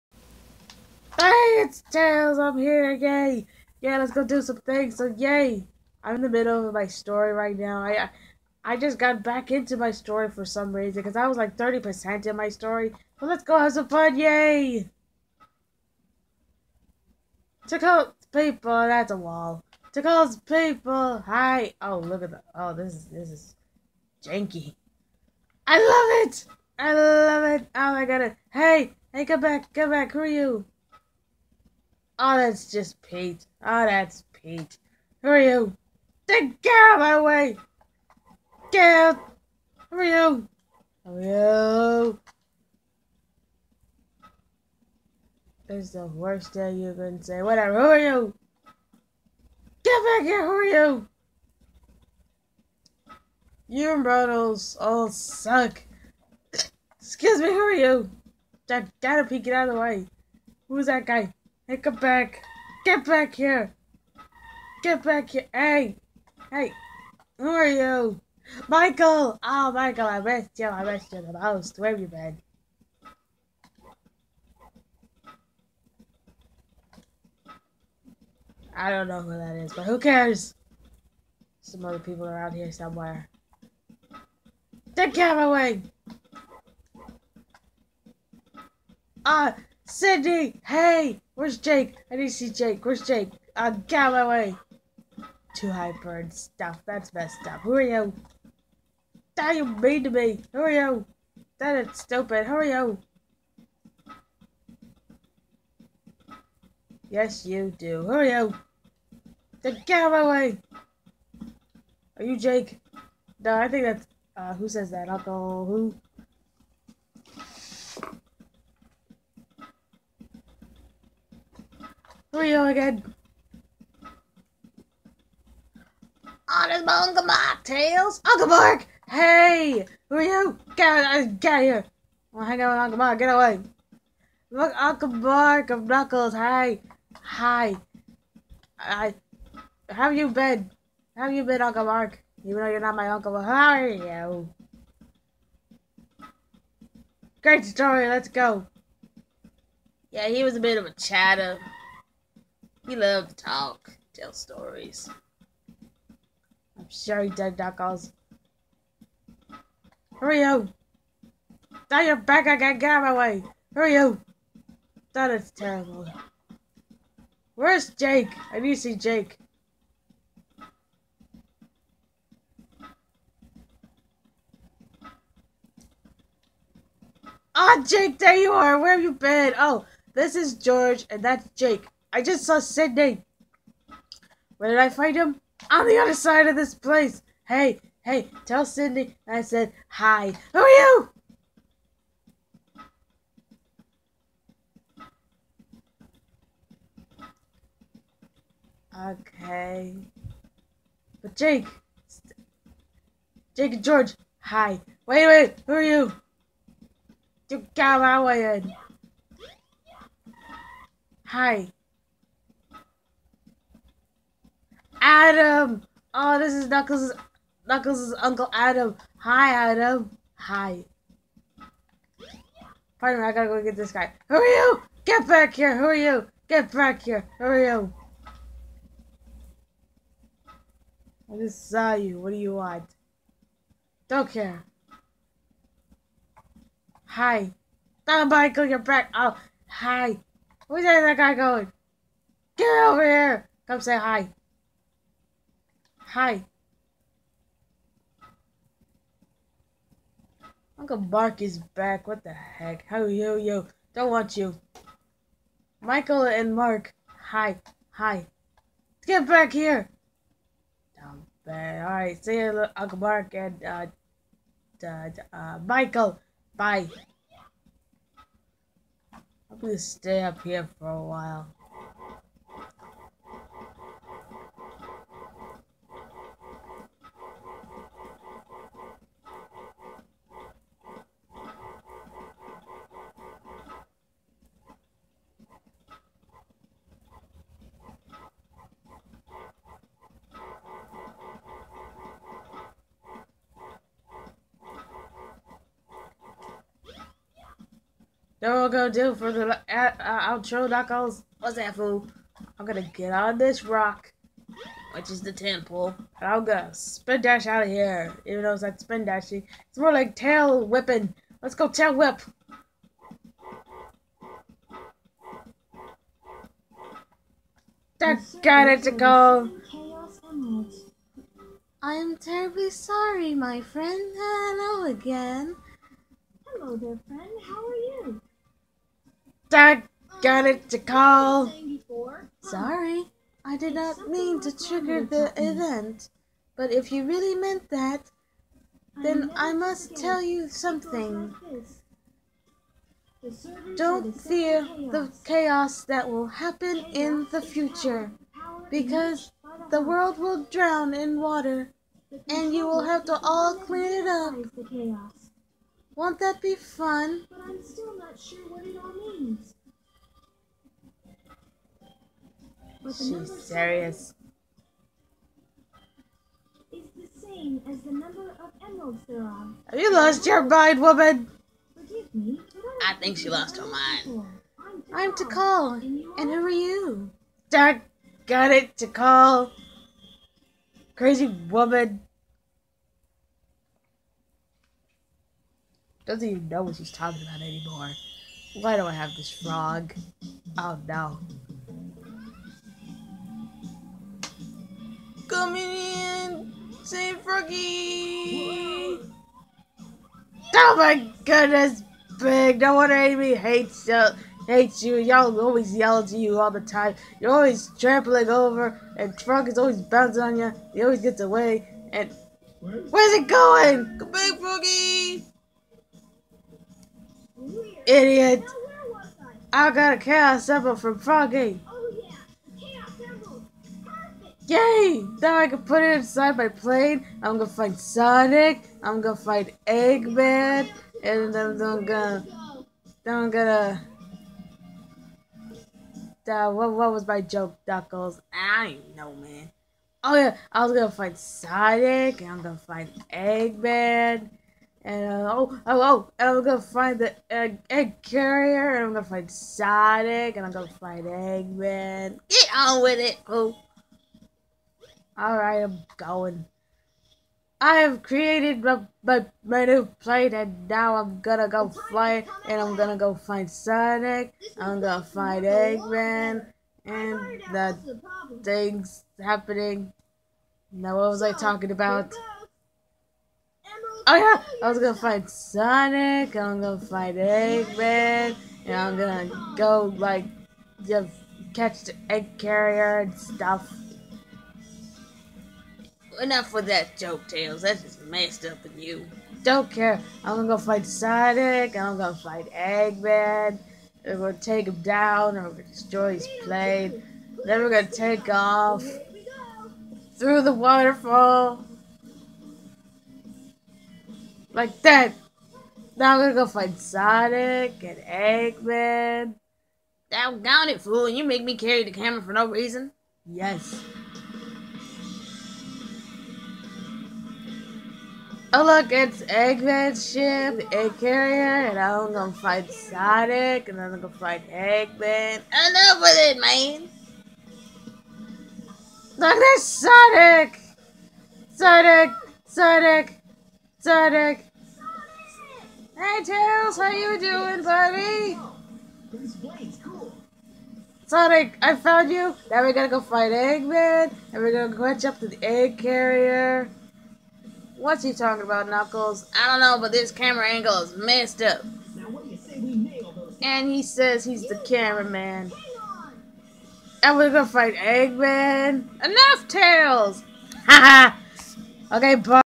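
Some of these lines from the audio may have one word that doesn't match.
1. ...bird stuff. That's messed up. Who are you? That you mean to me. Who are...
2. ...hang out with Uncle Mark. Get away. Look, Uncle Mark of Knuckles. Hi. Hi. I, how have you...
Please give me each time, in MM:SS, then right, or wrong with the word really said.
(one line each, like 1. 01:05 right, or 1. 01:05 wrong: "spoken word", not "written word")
1. 01:36 right
2. 02:12 right.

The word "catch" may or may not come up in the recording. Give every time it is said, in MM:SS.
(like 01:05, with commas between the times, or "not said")
08:01, 09:04.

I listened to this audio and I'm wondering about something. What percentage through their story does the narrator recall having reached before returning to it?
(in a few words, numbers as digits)
30%.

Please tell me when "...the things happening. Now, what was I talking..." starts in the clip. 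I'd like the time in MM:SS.
07:47.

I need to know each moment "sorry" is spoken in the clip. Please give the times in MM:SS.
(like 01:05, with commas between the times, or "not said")
05:22, 05:32.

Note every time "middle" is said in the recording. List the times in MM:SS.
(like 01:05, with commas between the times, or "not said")
00:06.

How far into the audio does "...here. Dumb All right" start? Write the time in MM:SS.
04:19.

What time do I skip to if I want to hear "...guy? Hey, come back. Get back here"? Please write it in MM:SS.
01:01.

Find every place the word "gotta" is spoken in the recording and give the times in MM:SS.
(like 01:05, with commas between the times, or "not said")
00:59, 03:43, 09:02.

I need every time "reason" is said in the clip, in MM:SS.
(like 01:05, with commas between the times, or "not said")
00:10, 08:32.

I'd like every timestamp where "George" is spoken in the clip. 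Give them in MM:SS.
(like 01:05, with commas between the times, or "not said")
03:00, 03:23.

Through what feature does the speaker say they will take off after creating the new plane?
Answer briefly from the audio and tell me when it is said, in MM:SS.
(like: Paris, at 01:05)
the waterfall, at 08:20.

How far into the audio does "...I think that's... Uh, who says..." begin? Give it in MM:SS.
01:53.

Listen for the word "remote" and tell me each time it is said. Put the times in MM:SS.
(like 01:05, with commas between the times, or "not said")
not said.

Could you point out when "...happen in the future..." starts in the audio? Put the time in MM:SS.
05:46.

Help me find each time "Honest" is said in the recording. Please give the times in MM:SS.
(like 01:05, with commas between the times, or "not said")
02:06.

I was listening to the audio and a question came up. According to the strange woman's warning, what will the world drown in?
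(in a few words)
water.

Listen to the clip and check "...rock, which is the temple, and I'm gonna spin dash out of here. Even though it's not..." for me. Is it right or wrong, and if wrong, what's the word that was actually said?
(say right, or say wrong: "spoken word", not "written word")
right.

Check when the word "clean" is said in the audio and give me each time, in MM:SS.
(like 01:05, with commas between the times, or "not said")
05:53.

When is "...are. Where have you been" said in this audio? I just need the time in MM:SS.
02:58.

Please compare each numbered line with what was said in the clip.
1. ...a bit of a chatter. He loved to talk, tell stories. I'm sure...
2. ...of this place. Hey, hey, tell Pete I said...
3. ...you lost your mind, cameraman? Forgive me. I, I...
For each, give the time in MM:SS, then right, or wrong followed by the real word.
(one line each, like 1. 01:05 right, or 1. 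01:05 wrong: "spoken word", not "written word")
1. 02:30 right
2. 03:06 wrong: "Sydney", not "Pete"
3. 06:09 wrong: "woman", not "cameraman".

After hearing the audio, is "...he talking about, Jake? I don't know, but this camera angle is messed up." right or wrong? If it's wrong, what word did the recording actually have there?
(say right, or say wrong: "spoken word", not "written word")
wrong: "Knuckles", not "Jake".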